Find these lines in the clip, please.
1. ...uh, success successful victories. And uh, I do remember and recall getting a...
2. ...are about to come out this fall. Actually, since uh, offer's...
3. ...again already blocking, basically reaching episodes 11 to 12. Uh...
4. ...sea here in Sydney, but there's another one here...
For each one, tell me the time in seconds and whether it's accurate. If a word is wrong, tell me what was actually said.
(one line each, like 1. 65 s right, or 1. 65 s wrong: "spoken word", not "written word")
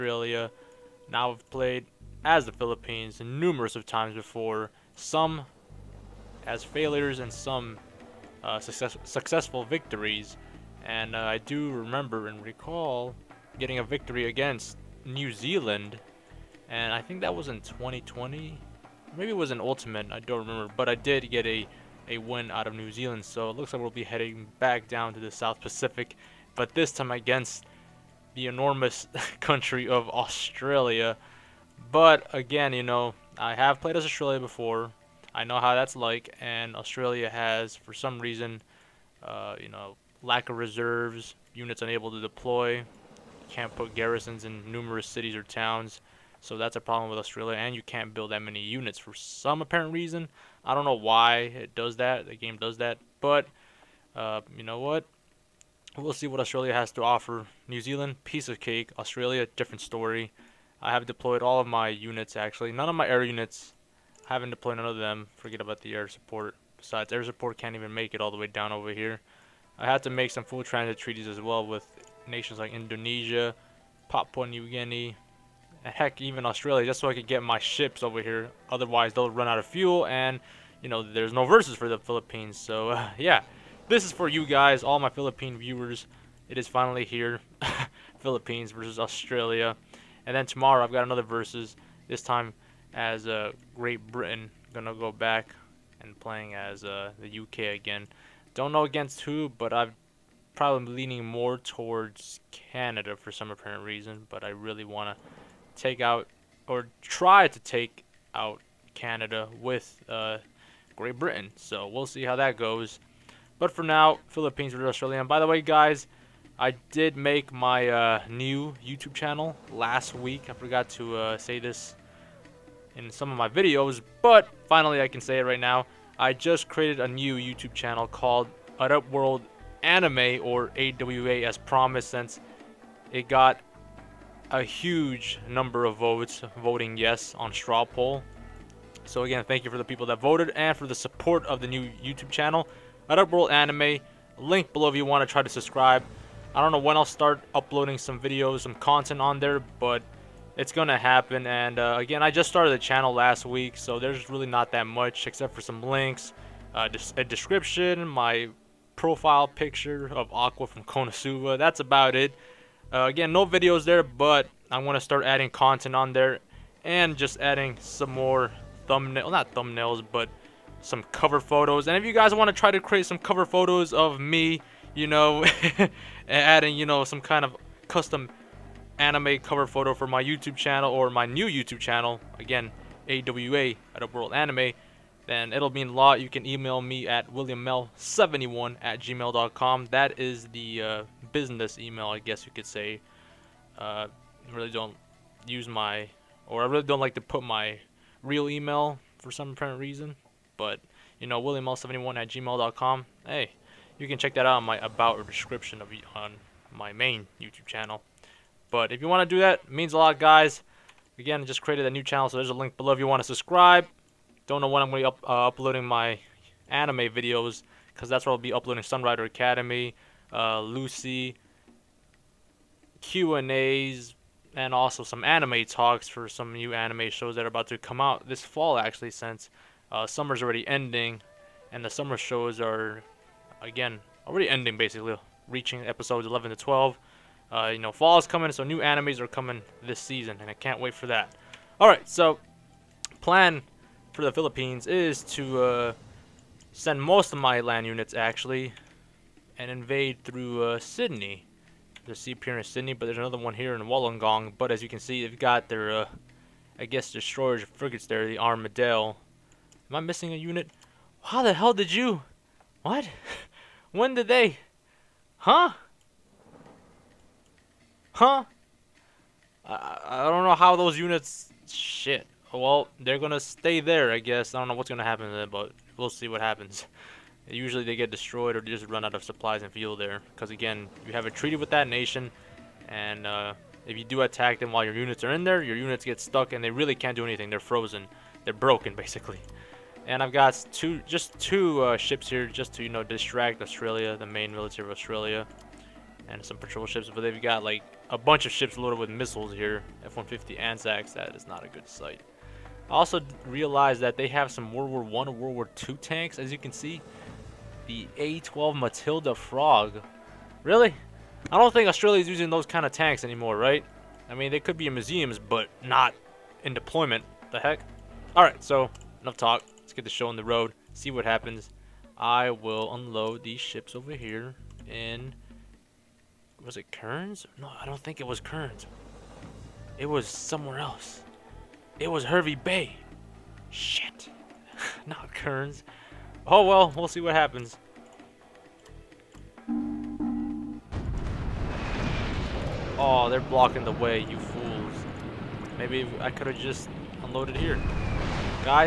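1. 8 s right
2. 227 s wrong: "summer", not "offer"
3. 233 s wrong: "ending", not "blocking"
4. 252 s right.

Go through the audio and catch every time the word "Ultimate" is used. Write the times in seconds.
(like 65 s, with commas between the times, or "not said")
19 s.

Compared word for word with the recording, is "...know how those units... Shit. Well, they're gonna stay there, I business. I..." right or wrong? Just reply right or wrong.
wrong.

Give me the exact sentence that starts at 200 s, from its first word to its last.
But, you know, williaml71 at gmail.com.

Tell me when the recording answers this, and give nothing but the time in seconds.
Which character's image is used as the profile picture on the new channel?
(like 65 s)
160 s.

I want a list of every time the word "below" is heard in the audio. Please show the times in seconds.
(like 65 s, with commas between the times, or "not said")
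144 s, 212 s.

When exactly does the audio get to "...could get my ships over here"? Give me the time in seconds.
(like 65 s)
77 s.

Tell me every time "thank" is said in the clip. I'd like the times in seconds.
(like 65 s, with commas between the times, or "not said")
139 s.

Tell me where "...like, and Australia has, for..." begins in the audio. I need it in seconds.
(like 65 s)
35 s.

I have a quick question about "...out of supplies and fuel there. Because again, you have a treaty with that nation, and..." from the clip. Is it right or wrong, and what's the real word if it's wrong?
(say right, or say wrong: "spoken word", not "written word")
right.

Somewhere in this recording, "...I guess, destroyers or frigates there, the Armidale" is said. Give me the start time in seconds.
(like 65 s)
256 s.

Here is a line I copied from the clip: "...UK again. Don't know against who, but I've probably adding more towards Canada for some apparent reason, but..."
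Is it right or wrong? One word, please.
wrong.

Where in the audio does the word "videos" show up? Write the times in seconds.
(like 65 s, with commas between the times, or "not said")
123 s, 148 s, 163 s, 216 s.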